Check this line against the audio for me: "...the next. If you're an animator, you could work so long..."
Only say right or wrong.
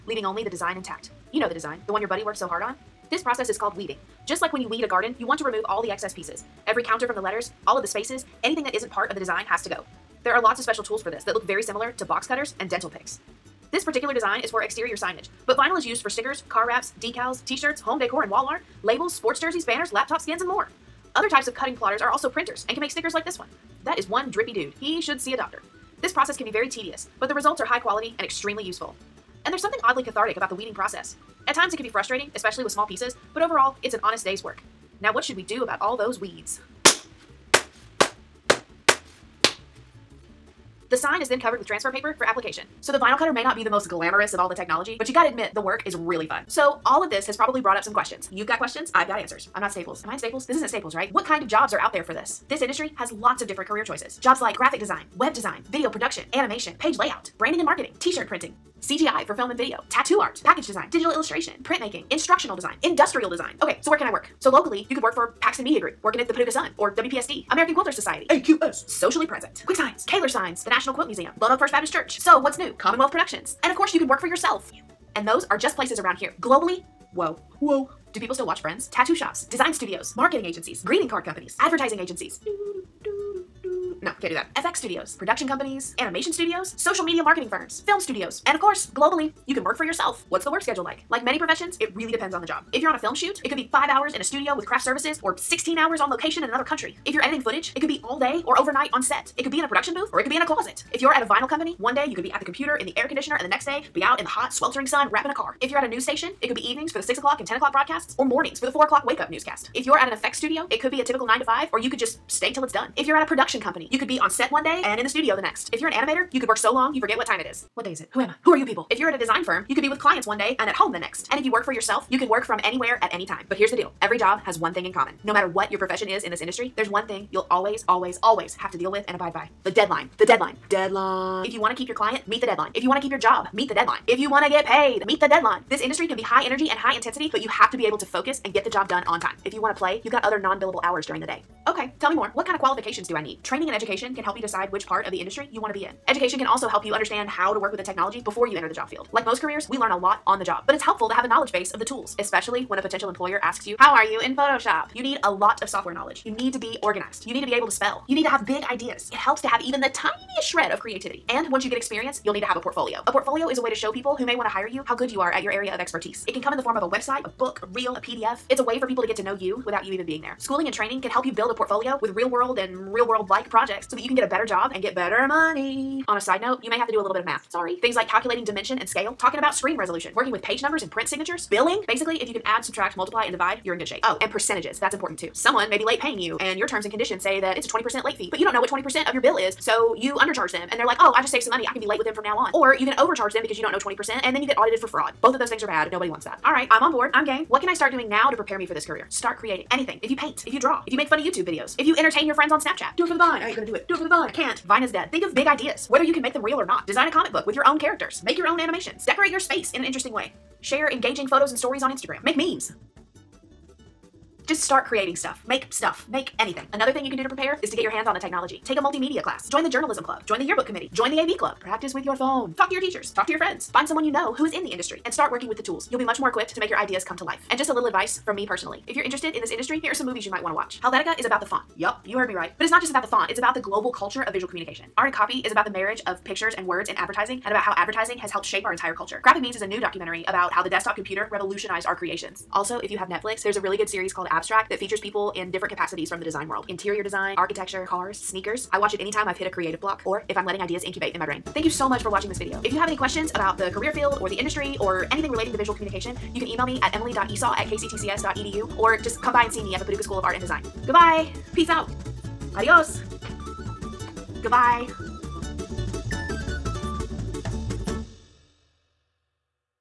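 right.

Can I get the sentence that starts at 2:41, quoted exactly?
And once you get experience, you'll need to have a portfolio.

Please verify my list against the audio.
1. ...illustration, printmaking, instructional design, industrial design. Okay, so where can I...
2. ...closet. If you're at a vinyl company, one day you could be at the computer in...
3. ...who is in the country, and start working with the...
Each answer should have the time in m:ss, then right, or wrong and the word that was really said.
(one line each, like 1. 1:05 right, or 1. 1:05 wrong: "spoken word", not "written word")
1. 1:01 right
2. 1:40 right
3. 3:44 wrong: "industry", not "country".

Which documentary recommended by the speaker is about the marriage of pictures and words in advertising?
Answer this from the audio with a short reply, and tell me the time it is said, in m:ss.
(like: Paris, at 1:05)
Art and Copy, at 3:54.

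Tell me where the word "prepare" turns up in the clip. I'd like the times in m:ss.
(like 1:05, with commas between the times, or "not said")
3:18, 3:37.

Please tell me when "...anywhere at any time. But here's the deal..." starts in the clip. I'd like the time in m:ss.
2:02.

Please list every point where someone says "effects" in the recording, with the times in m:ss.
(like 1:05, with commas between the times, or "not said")
1:50.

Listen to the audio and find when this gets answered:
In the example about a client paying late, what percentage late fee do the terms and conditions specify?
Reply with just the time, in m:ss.
3:07.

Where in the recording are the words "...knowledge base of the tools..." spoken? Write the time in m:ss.
2:31.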